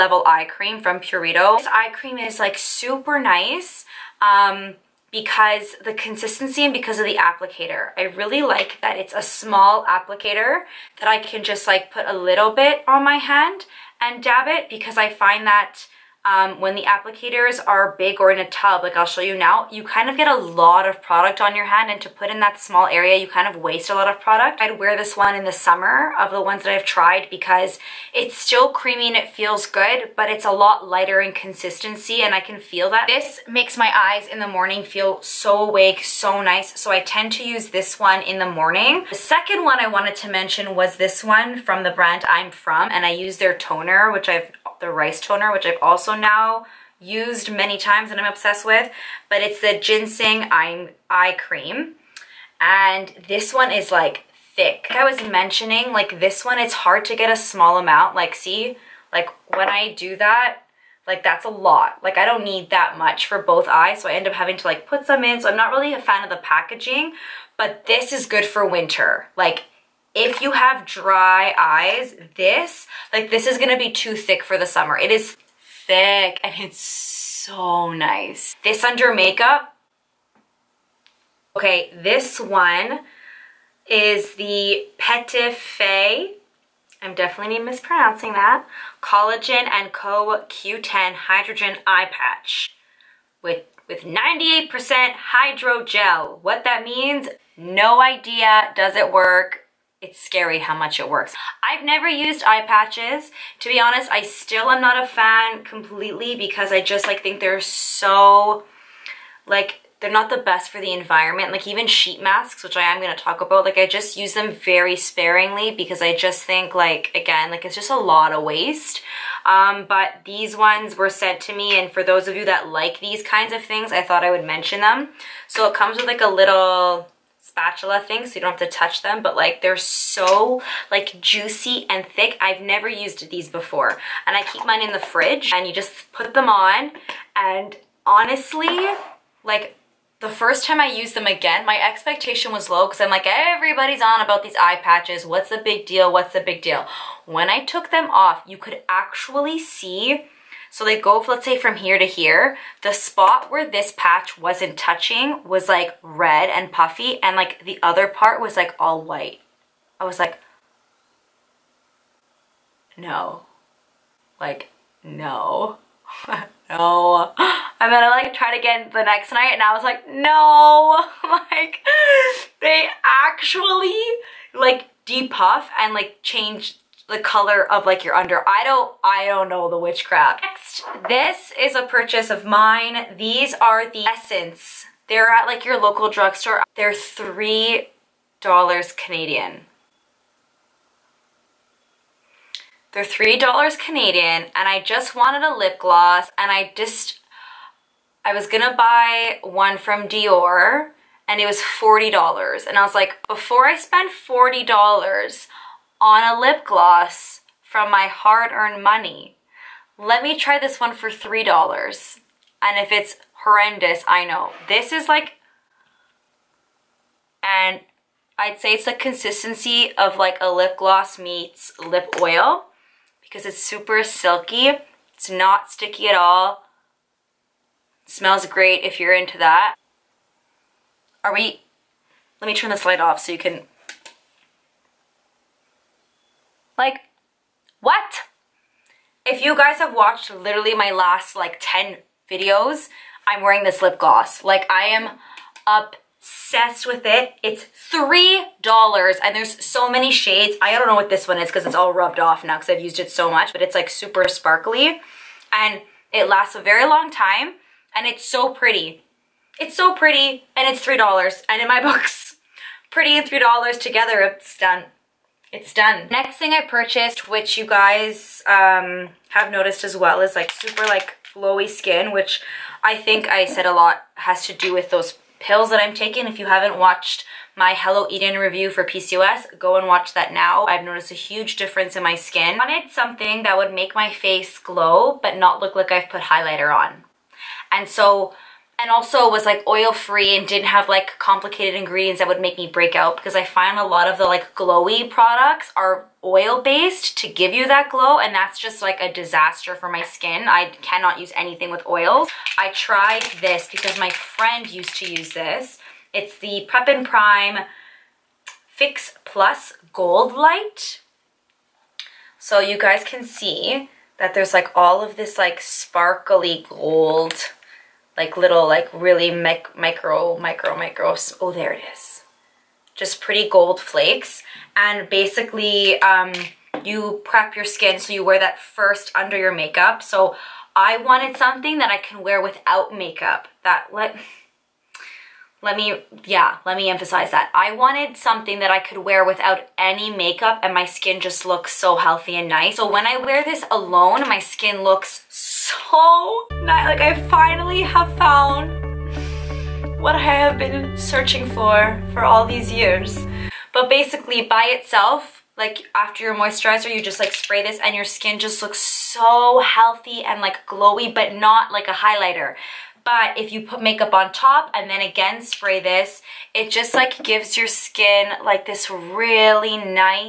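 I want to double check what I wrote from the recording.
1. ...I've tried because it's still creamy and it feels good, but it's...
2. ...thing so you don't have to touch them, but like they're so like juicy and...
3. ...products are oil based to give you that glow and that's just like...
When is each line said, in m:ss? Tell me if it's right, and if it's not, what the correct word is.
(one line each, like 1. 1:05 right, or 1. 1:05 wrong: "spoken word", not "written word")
1. 0:26 right
2. 2:07 right
3. 4:55 right.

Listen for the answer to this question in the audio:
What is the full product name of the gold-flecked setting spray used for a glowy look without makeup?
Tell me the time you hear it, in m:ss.
5:06.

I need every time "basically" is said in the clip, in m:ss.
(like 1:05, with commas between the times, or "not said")
5:25, 5:53.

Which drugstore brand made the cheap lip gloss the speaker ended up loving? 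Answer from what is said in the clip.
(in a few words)
Essence.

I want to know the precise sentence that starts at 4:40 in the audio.
I've noticed a huge difference in my skin.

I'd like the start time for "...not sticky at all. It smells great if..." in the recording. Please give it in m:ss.
3:45.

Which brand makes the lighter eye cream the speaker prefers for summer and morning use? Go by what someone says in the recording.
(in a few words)
Purito.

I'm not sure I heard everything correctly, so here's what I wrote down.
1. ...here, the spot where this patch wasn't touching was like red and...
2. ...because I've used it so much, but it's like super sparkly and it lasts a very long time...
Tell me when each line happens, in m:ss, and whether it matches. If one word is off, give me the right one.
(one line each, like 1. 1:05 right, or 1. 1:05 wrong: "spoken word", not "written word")
1. 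2:32 right
2. 4:12 right.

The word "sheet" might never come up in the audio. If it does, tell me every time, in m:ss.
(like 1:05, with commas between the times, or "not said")
1:51.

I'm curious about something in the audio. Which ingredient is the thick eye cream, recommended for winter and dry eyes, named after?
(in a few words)
Ginseng.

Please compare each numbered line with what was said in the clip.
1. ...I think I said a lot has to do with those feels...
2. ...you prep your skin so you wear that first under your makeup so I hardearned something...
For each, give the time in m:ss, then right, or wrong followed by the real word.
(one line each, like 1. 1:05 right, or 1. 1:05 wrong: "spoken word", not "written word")
1. 4:32 wrong: "pills", not "feels"
2. 5:26 wrong: "wanted", not "hardearned".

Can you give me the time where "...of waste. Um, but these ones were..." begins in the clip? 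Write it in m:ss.
1:58.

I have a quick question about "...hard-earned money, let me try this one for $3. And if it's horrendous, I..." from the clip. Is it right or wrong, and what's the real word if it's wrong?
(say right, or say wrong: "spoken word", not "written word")
right.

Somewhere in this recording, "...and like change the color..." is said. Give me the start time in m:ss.
2:55.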